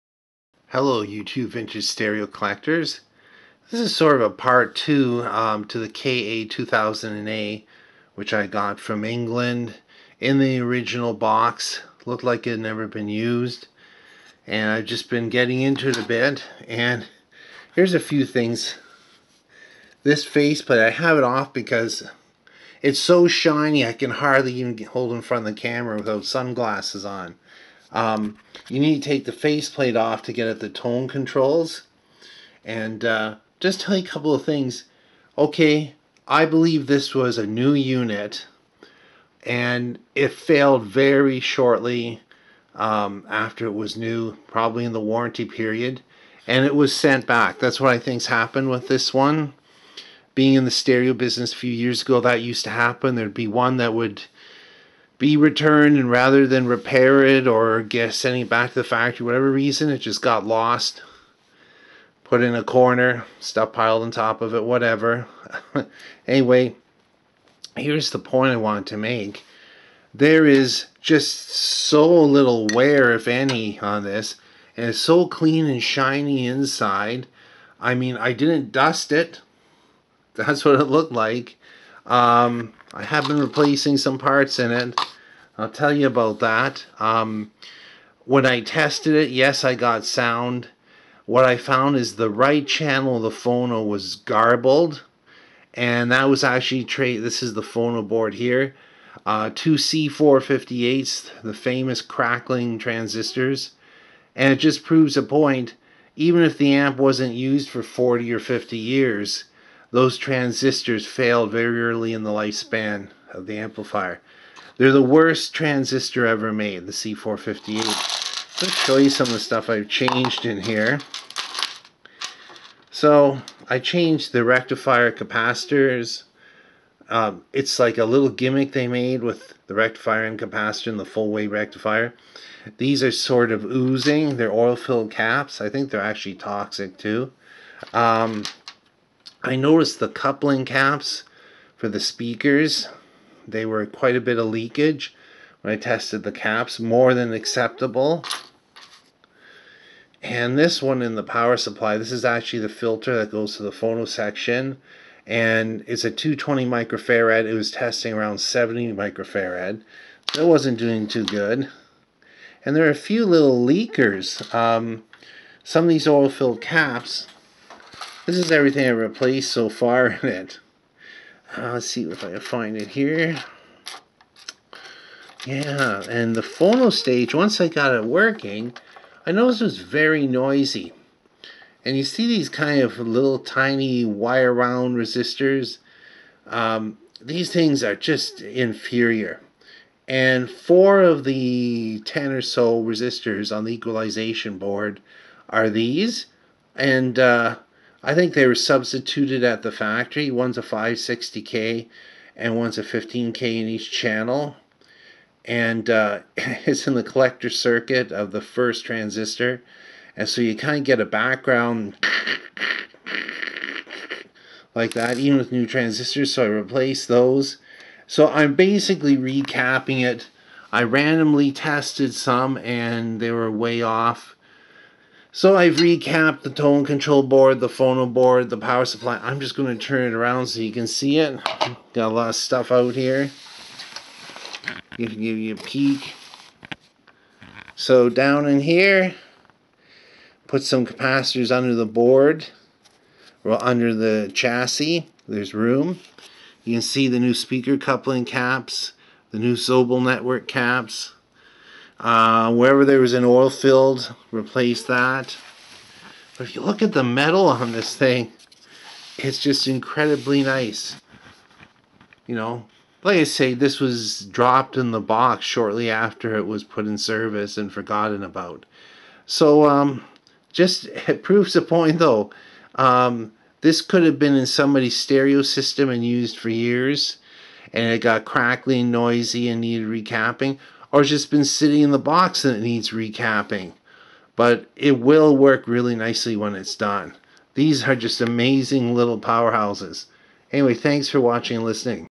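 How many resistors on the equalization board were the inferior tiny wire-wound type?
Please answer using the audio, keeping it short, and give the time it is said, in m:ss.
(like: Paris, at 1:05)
4, at 3:10.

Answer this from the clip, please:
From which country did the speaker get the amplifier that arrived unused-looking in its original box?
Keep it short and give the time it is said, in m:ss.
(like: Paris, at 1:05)
England, at 0:09.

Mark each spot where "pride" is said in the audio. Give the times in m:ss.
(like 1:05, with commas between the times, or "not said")
not said.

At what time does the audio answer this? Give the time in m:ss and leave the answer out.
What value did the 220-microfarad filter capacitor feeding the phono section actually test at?
2:38.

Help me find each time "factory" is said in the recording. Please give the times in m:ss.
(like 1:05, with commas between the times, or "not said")
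0:58, 3:19.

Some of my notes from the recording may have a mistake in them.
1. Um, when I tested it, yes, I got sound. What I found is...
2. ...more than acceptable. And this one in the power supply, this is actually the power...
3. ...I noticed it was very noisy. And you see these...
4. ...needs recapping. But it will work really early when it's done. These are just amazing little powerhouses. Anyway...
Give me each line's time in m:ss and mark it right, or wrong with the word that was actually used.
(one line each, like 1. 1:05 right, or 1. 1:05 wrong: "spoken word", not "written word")
1. 1:26 right
2. 2:26 wrong: "filter", not "power"
3. 2:59 right
4. 4:42 wrong: "nicely", not "early".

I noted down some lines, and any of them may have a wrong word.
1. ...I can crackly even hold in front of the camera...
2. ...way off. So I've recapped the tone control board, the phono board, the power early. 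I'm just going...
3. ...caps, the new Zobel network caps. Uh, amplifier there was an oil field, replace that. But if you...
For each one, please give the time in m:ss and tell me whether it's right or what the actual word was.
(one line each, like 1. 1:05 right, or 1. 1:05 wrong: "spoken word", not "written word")
1. 0:23 wrong: "hardly", not "crackly"
2. 3:43 wrong: "supply", not "early"
3. 4:08 wrong: "wherever", not "amplifier".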